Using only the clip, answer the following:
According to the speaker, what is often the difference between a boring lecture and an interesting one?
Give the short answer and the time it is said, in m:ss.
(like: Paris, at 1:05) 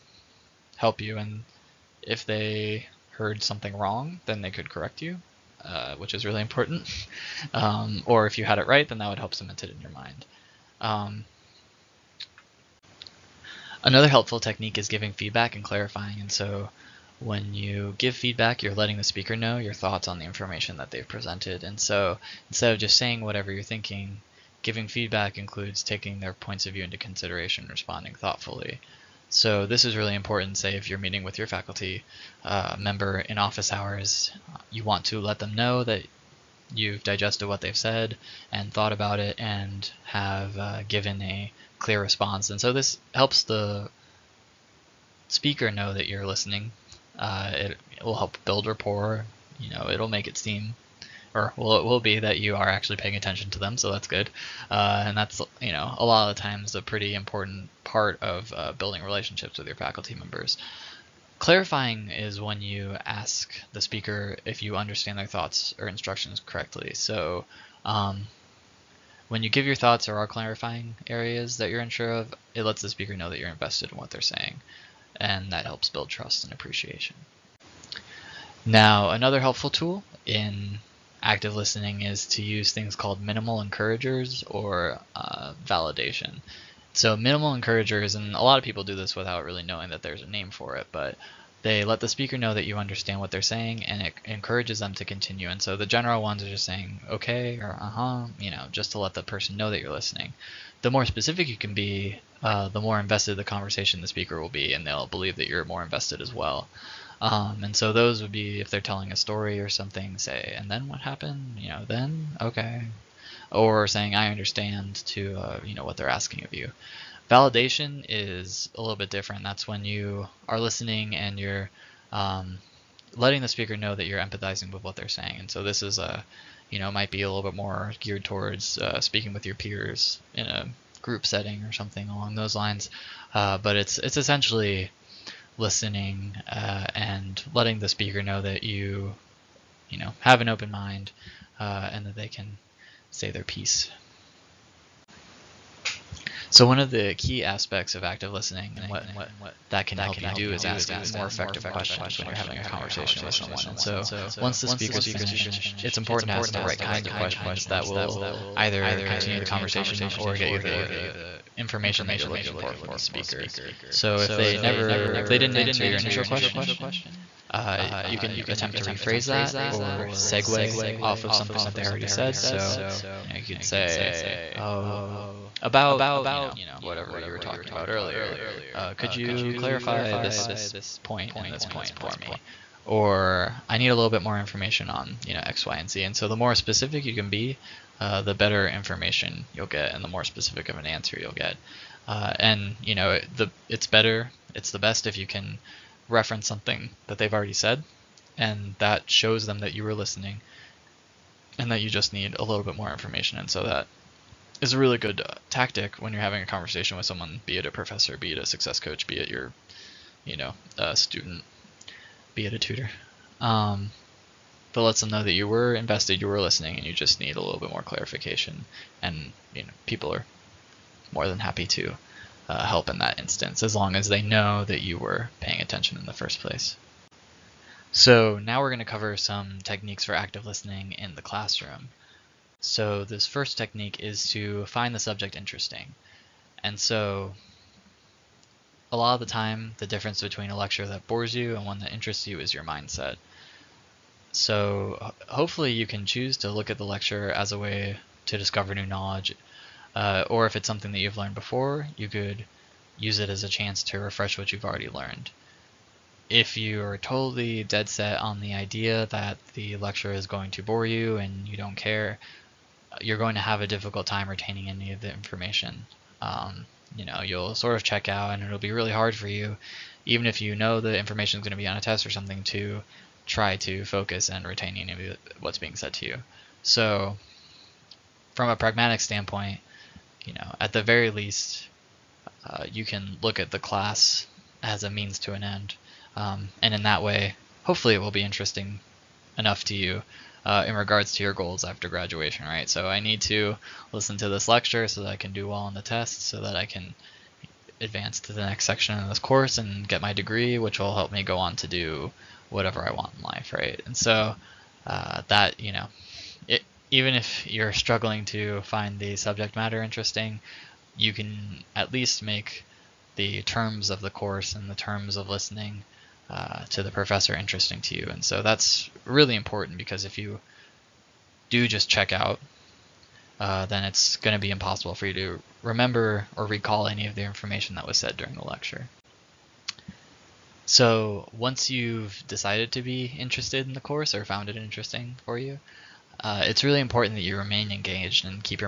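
your mindset, at 4:02.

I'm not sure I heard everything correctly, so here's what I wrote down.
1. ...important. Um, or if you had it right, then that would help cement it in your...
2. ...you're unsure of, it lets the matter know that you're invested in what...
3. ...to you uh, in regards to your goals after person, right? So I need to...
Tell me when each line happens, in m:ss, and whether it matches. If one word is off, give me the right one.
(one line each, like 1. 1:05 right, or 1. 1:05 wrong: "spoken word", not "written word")
1. 0:06 right
2. 1:11 wrong: "speaker", not "matter"
3. 4:49 wrong: "graduation", not "person".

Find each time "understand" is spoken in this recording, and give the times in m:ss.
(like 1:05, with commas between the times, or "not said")
1:04, 1:32, 1:54.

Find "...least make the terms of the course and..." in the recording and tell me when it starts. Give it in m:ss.
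5:11.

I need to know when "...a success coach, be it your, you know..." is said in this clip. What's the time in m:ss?
3:28.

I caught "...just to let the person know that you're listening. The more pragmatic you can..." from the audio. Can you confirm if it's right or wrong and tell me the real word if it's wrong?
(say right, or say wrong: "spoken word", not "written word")
wrong: "specific", not "pragmatic".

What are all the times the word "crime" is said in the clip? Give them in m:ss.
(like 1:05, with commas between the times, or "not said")
not said.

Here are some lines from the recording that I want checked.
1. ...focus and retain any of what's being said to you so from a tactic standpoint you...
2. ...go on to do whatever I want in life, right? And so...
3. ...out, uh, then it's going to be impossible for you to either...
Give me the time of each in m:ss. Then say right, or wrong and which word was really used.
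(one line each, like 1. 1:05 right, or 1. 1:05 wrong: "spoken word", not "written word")
1. 4:33 wrong: "pragmatic", not "tactic"
2. 5:01 right
3. 5:22 wrong: "remember", not "either".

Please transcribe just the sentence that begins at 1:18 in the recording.
Now, another helpful tool in active listening is to use things called minimal encouragers or uh, validation.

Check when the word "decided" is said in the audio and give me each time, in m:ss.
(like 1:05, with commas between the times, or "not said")
5:32.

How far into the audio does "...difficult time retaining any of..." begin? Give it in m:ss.
4:23.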